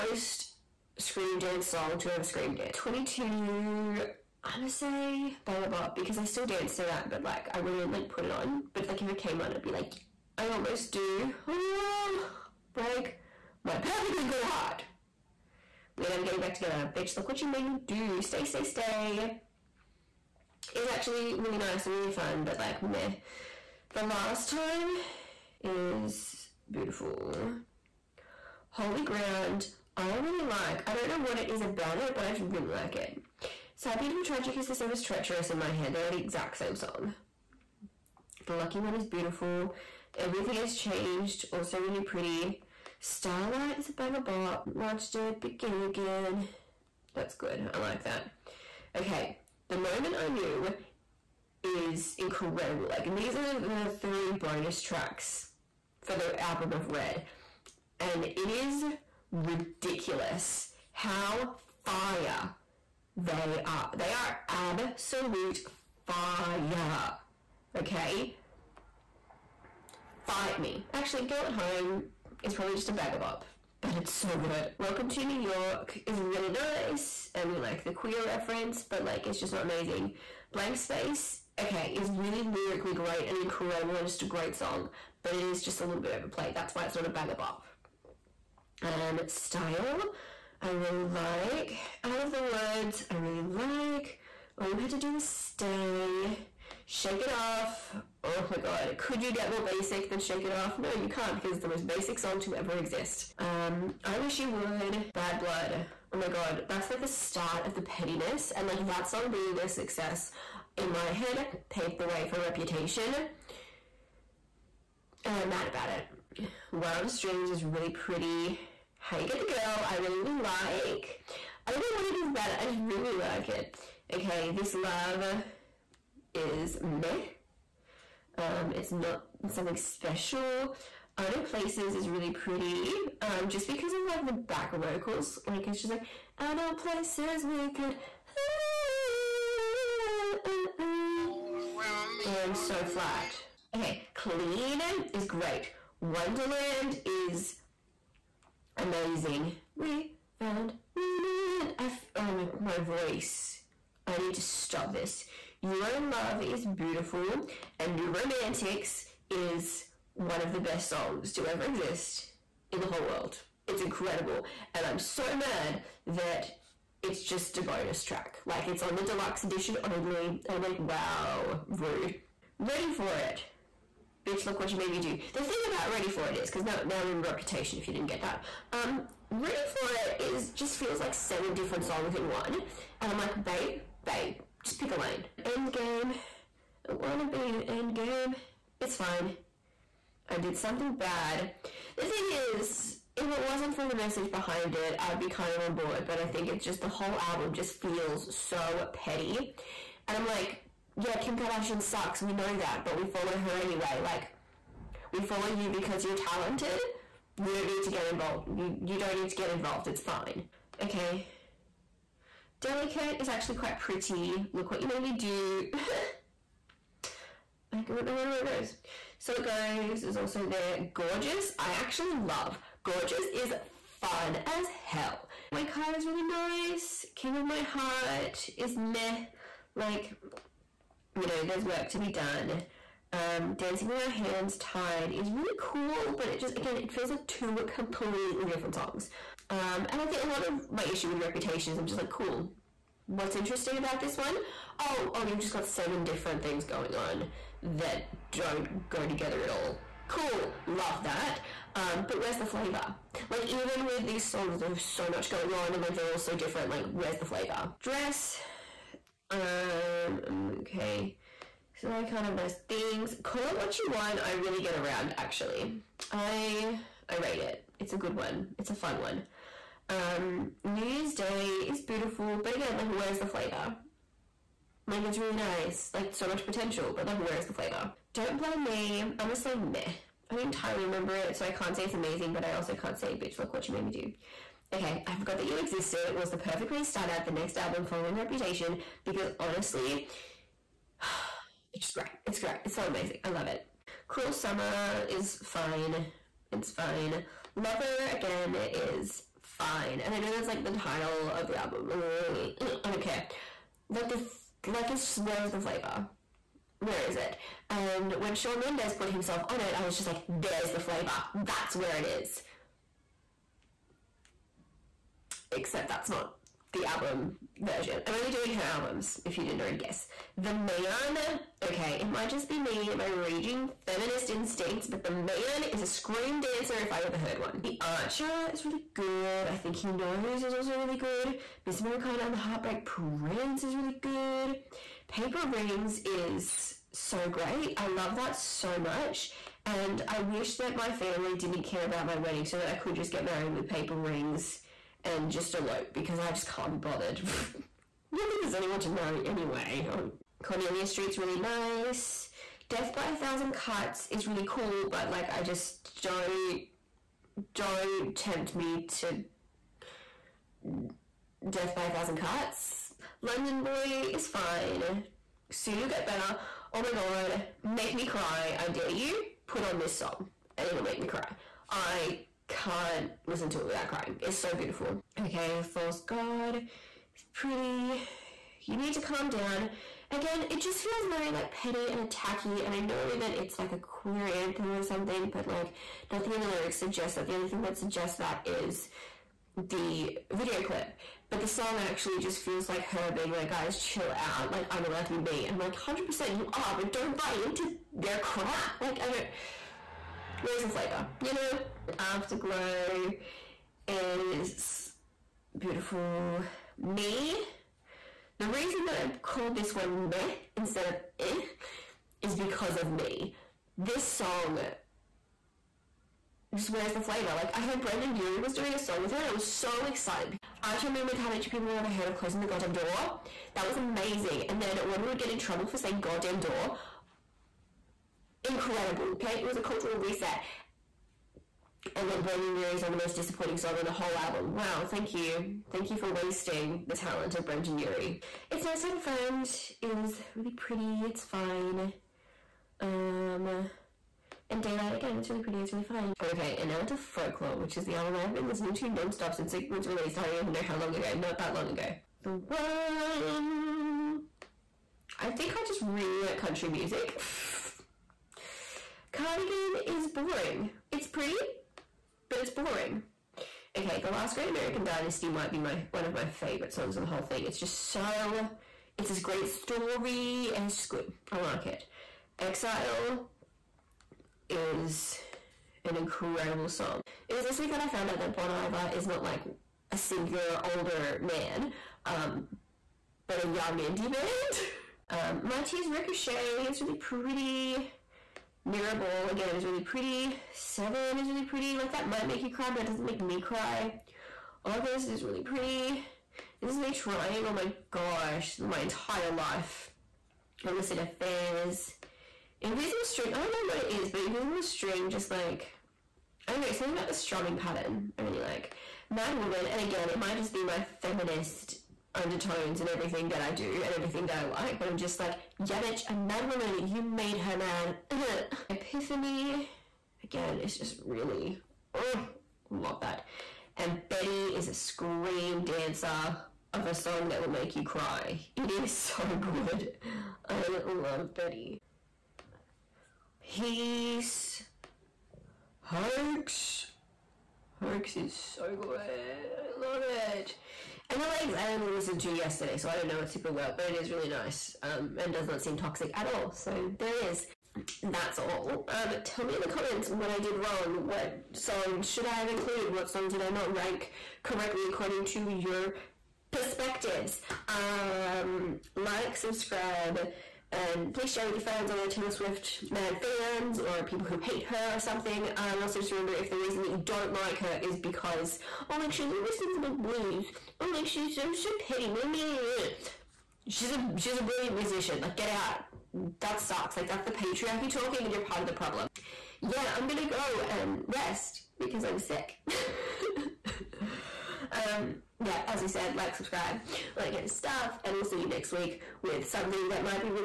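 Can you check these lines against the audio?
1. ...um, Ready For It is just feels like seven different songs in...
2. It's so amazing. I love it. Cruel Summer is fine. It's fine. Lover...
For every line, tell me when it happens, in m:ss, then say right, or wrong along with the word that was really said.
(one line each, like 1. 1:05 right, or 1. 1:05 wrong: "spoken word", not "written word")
1. 2:58 right
2. 4:52 right.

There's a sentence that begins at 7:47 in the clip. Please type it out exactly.
It's just so, it's this great story and it's just good.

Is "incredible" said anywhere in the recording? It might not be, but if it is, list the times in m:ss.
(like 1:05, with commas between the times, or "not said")
0:52, 1:23, 2:43, 7:08, 7:55.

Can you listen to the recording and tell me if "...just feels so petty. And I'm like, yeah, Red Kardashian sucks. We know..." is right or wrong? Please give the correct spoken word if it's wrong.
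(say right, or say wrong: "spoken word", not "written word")
wrong: "Kim", not "Red".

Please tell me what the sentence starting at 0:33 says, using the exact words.
Sad, Beautiful, Tragic is the same as Treacherous in my head.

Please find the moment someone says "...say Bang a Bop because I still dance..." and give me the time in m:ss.
0:04.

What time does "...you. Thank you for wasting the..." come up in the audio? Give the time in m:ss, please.
7:15.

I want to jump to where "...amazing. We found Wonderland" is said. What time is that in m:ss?
2:28.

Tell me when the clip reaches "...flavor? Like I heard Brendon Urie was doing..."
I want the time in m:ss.
6:57.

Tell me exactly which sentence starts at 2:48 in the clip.
Like, it's on the deluxe edition only, and I'm like, wow, rude.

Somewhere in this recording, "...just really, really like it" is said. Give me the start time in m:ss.
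2:02.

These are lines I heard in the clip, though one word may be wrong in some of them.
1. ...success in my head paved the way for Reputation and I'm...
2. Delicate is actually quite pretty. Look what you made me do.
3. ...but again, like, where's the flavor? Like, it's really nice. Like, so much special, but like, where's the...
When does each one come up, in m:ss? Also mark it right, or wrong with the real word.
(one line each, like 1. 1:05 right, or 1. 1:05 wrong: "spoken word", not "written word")
1. 1:49 right
2. 3:32 right
3. 4:32 wrong: "potential", not "special".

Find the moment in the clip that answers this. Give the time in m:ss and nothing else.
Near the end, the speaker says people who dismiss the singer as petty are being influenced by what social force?
9:37.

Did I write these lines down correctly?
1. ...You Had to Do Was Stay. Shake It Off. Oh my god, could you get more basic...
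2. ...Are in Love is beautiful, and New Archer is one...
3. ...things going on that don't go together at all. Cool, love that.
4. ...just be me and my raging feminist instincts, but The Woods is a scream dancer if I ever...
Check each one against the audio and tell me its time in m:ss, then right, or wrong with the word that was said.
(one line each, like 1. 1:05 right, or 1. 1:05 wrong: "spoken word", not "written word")
1. 1:34 right
2. 2:35 wrong: "Romantics", not "Archer"
3. 4:06 right
4. 5:22 wrong: "Man", not "Woods".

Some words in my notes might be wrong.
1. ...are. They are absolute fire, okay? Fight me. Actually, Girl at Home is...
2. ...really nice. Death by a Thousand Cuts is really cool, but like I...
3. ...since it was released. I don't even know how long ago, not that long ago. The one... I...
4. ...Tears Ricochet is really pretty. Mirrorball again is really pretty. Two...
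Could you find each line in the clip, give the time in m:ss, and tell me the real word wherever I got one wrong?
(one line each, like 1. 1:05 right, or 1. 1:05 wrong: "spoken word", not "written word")
1. 1:03 right
2. 5:51 right
3. 7:29 right
4. 8:05 wrong: "Seven", not "Two".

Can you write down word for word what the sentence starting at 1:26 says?
That's why it's not a bag of up um, style.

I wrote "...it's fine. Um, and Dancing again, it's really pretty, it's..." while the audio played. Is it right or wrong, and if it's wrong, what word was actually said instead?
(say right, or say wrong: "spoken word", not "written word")
wrong: "Daylight", not "Dancing".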